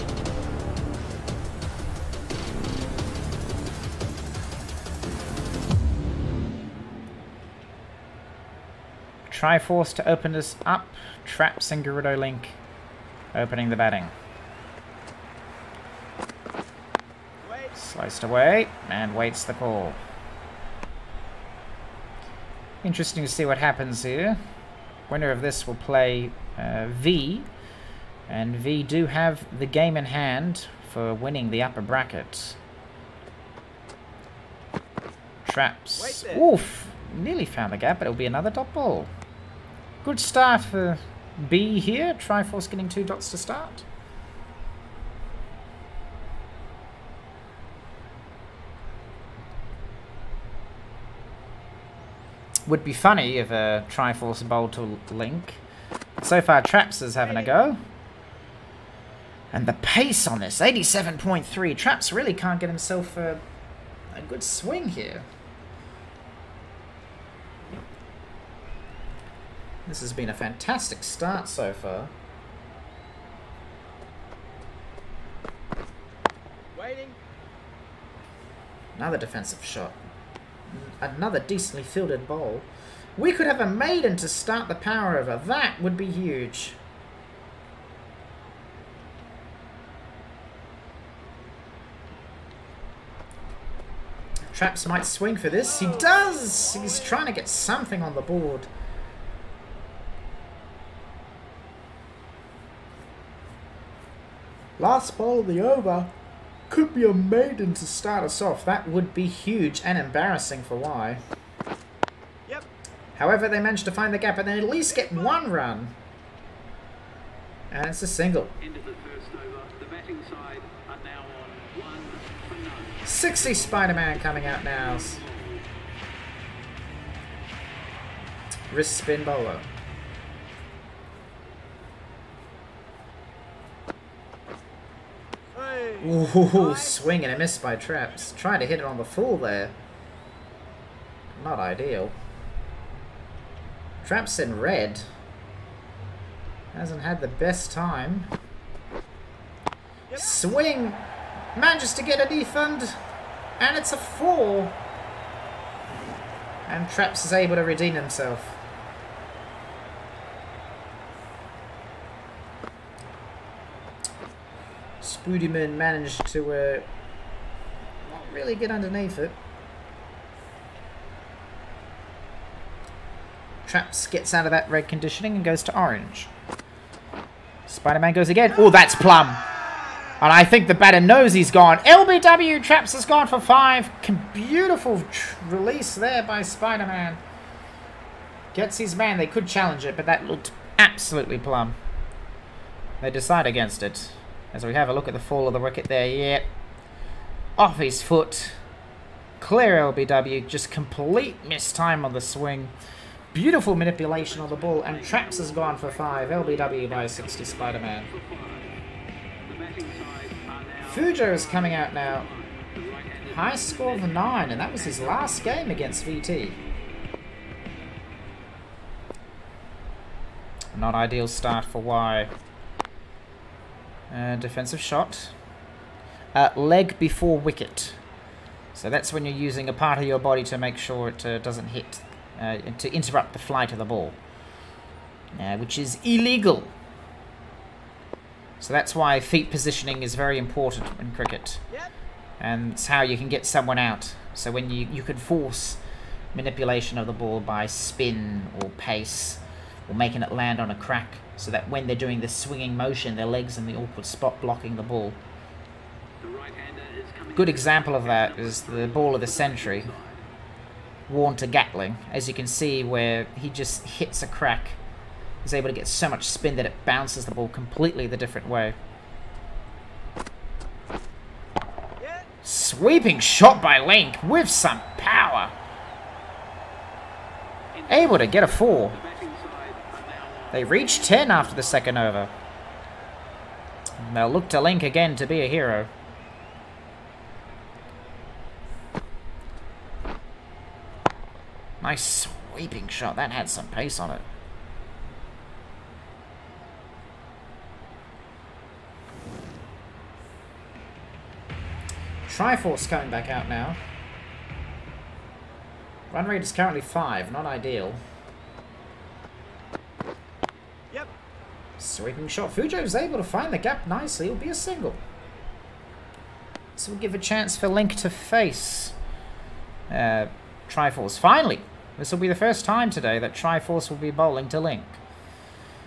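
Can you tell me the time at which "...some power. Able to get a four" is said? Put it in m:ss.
4:34.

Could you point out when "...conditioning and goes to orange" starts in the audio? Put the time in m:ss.
2:54.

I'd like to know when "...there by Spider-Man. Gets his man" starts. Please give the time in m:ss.
3:05.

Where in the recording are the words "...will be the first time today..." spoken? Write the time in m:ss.
5:22.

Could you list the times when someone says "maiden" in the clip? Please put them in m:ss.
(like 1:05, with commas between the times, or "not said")
1:23, 1:47.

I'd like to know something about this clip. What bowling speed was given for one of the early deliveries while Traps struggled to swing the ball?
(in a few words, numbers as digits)
87.3.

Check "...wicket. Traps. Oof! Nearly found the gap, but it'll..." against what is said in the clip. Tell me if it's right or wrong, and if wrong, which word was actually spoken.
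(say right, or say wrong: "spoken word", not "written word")
wrong: "bracket", not "wicket".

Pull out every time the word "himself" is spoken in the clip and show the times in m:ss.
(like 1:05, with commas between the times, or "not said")
1:02, 2:37.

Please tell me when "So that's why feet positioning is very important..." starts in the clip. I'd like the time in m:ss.
3:58.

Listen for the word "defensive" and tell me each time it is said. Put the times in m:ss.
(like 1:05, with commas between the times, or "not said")
1:19, 3:44.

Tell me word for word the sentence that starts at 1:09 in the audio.
This has been a fantastic start so far.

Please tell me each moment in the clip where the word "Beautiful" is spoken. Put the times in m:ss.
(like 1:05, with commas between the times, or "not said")
3:04, 3:23.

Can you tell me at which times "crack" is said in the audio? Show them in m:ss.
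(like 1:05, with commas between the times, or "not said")
4:10, 4:24.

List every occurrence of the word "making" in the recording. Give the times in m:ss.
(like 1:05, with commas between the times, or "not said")
4:09.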